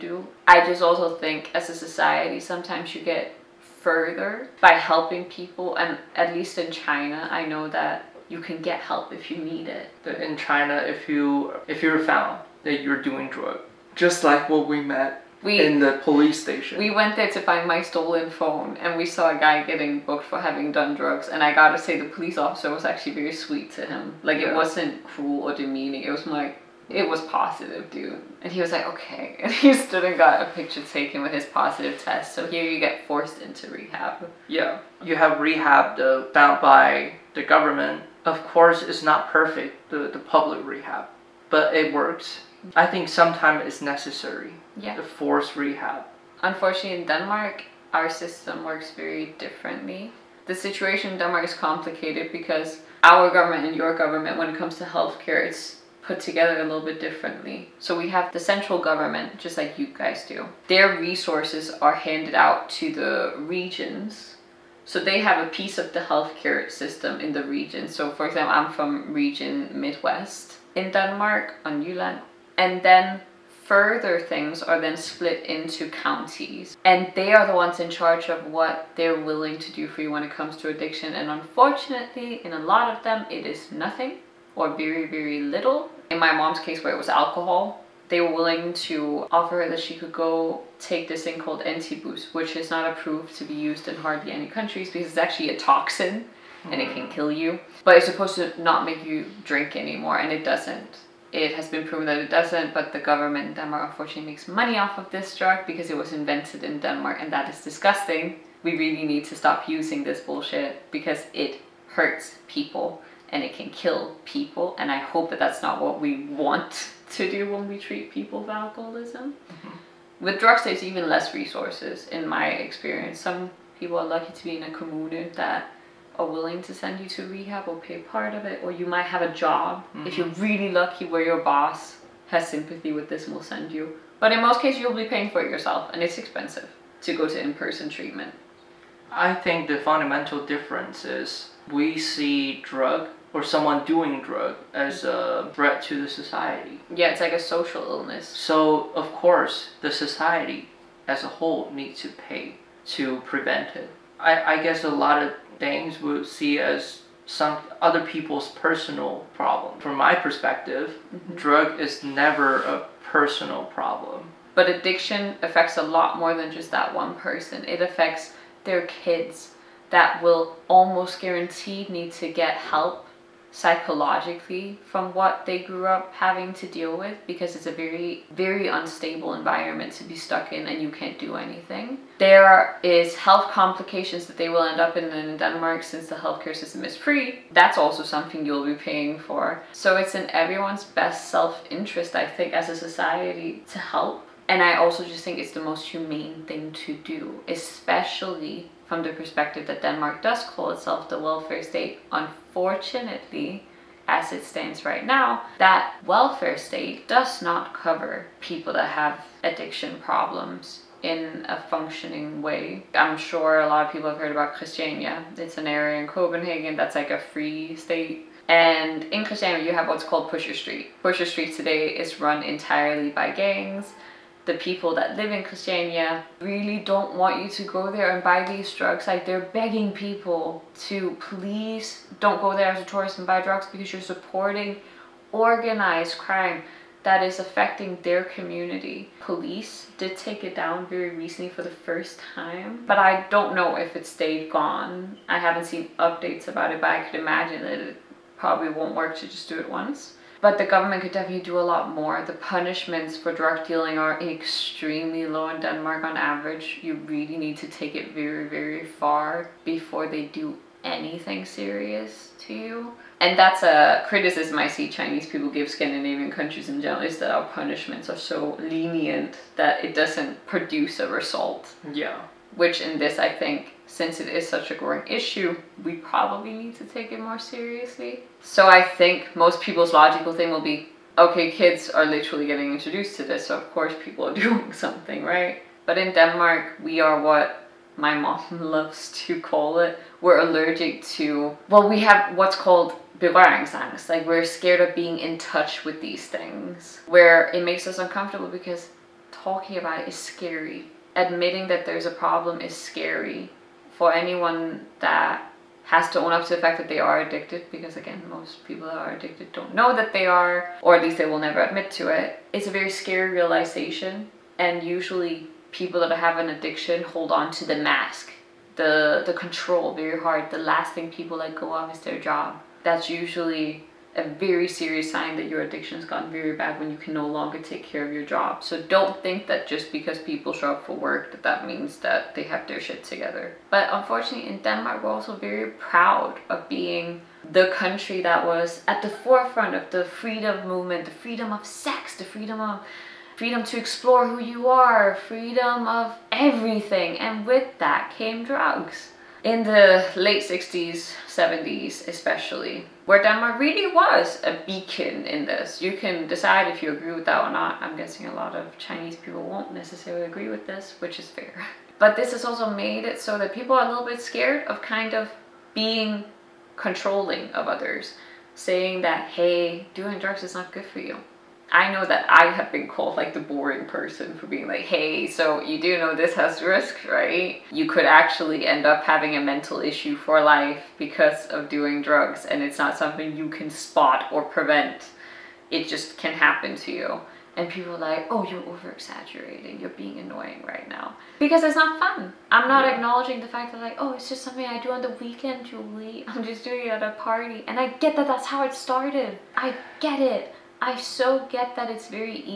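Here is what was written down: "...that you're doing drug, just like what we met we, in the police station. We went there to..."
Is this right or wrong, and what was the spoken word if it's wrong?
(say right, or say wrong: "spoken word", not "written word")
right.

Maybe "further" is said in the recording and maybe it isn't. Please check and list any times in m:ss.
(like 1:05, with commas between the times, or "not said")
0:03, 1:13.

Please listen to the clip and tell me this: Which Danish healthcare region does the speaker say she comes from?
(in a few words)
Region Midwest.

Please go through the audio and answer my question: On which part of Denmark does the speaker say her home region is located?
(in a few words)
Jylland.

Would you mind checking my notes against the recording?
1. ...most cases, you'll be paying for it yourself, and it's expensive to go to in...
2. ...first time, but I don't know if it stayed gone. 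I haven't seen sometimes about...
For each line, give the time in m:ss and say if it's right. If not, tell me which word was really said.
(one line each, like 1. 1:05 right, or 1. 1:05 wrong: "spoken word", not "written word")
1. 2:14 right
2. 4:01 wrong: "updates", not "sometimes".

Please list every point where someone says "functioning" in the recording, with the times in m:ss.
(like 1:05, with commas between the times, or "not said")
3:31.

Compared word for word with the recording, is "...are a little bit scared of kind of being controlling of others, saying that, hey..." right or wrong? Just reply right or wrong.
right.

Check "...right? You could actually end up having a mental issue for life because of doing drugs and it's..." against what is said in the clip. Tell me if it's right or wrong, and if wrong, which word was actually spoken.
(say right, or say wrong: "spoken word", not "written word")
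right.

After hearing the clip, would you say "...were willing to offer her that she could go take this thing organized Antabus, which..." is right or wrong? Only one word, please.
wrong.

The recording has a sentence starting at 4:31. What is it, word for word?
Yeah which in this I think since it is such a growing issue, we probably need to take it more seriously.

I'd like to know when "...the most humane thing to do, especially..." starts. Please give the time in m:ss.
3:15.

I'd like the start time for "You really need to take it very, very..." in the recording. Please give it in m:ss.
4:16.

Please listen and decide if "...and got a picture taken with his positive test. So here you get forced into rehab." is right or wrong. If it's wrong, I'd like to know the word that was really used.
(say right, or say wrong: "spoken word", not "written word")
right.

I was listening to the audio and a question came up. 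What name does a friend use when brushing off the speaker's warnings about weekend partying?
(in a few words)
Julie.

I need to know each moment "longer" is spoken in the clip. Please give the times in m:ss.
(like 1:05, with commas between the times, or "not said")
5:27.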